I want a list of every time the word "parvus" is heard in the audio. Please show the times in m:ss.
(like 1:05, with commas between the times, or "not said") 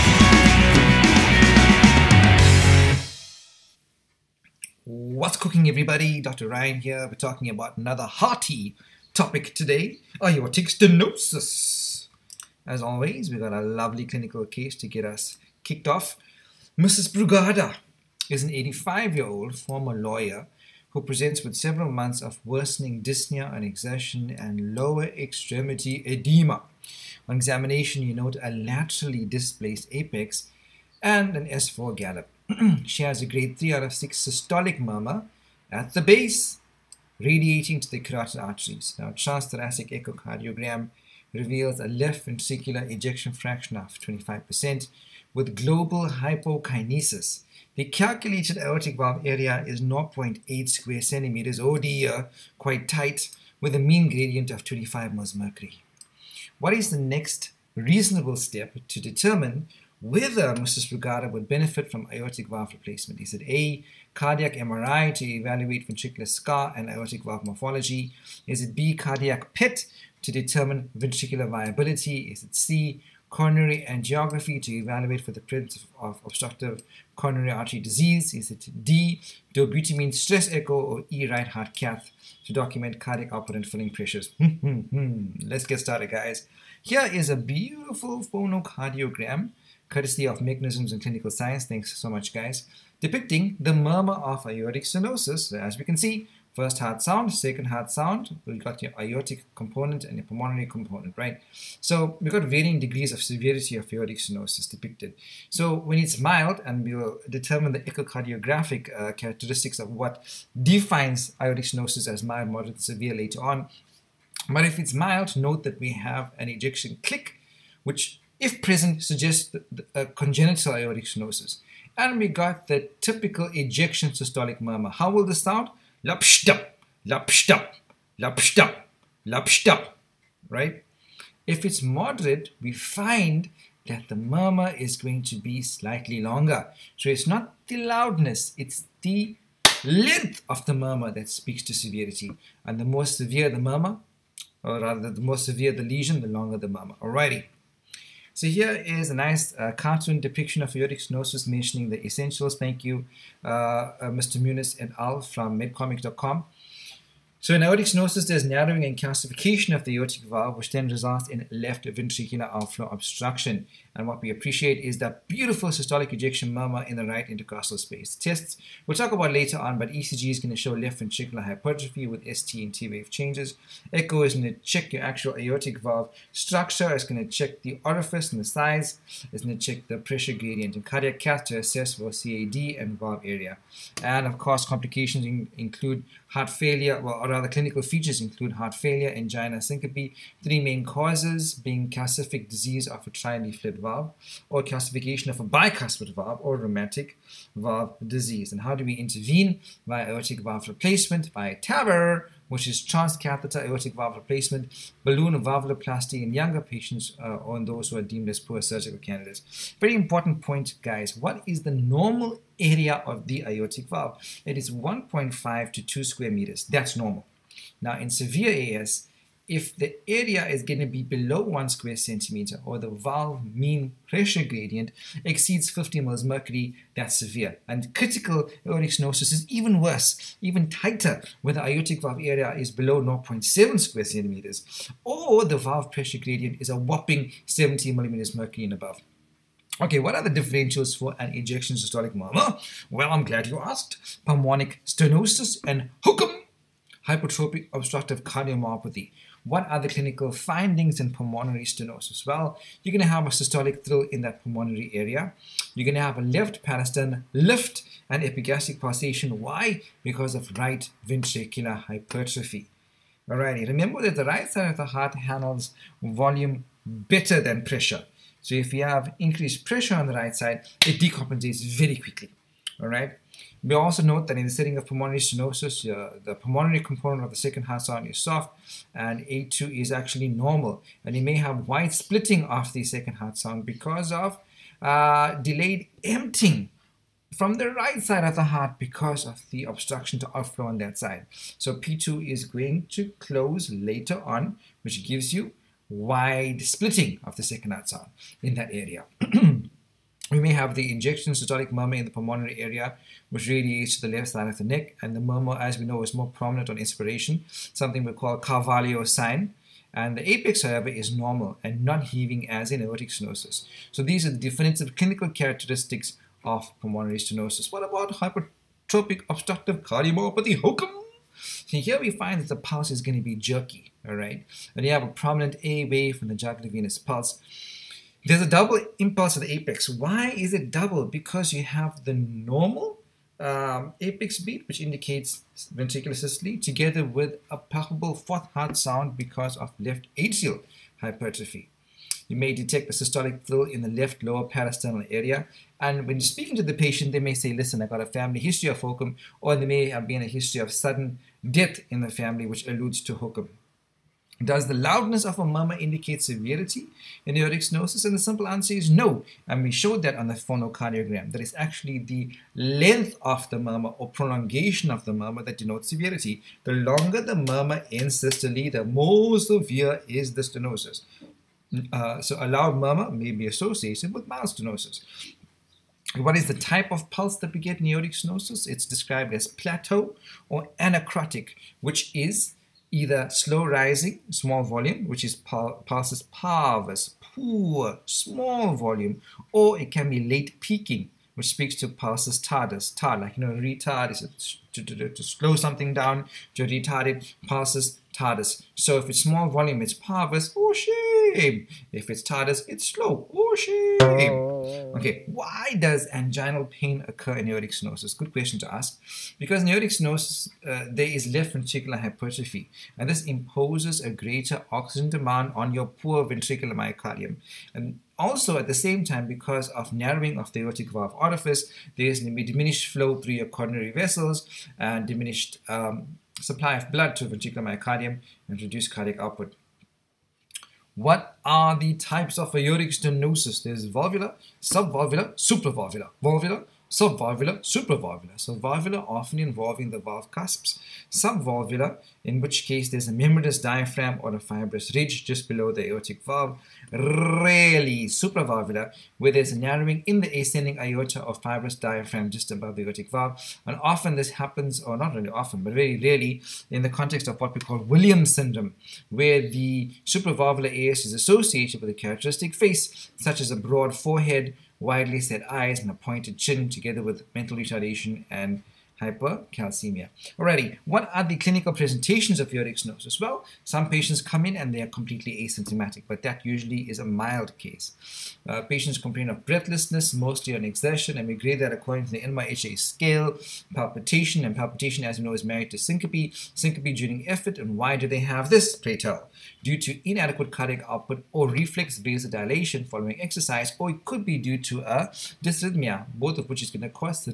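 6:26, 6:39.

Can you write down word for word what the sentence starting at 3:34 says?
It is 1.5 to 2 square meters.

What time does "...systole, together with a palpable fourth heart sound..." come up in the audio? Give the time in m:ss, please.
5:36.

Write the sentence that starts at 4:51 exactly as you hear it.
So P2 is going to close later on, which gives you wide splitting of the second heart sound in that area.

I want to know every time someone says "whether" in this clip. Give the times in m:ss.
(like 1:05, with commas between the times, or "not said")
1:00.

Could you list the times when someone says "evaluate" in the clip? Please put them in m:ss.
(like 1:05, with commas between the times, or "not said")
1:05, 1:14.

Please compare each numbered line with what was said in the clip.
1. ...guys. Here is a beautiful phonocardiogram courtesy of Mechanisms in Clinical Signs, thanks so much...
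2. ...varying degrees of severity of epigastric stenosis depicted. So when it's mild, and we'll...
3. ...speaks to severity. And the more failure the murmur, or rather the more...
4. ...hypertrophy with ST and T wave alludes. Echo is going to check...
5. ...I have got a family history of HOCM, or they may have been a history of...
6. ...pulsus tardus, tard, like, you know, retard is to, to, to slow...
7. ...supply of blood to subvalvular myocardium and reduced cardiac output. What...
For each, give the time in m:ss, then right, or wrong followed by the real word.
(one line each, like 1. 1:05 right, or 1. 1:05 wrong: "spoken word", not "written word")
1. 1:26 right
2. 1:42 wrong: "aortic", not "epigastric"
3. 2:21 wrong: "severe", not "failure"
4. 2:51 wrong: "changes", not "alludes"
5. 5:47 right
6. 6:31 right
7. 7:06 wrong: "ventricular", not "subvalvular".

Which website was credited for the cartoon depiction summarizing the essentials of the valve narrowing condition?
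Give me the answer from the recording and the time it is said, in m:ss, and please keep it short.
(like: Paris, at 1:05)
medcomic.com, at 2:35.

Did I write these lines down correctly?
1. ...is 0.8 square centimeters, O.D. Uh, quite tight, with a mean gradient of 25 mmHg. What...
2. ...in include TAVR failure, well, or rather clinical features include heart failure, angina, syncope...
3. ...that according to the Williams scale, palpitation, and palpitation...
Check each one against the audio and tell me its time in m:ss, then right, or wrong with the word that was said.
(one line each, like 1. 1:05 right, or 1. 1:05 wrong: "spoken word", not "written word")
1. 0:49 right
2. 3:05 wrong: "Heart", not "TAVR"
3. 8:01 wrong: "NYHA", not "Williams".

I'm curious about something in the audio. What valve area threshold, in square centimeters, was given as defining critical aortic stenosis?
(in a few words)
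0.7.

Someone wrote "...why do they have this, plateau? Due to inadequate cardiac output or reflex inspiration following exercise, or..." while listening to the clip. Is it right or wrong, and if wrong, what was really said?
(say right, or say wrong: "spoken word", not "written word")
wrong: "vasodilation", not "inspiration".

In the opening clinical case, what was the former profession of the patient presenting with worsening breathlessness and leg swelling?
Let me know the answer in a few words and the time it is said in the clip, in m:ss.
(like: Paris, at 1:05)
lawyer, at 0:19.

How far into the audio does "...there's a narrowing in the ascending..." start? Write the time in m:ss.
7:29.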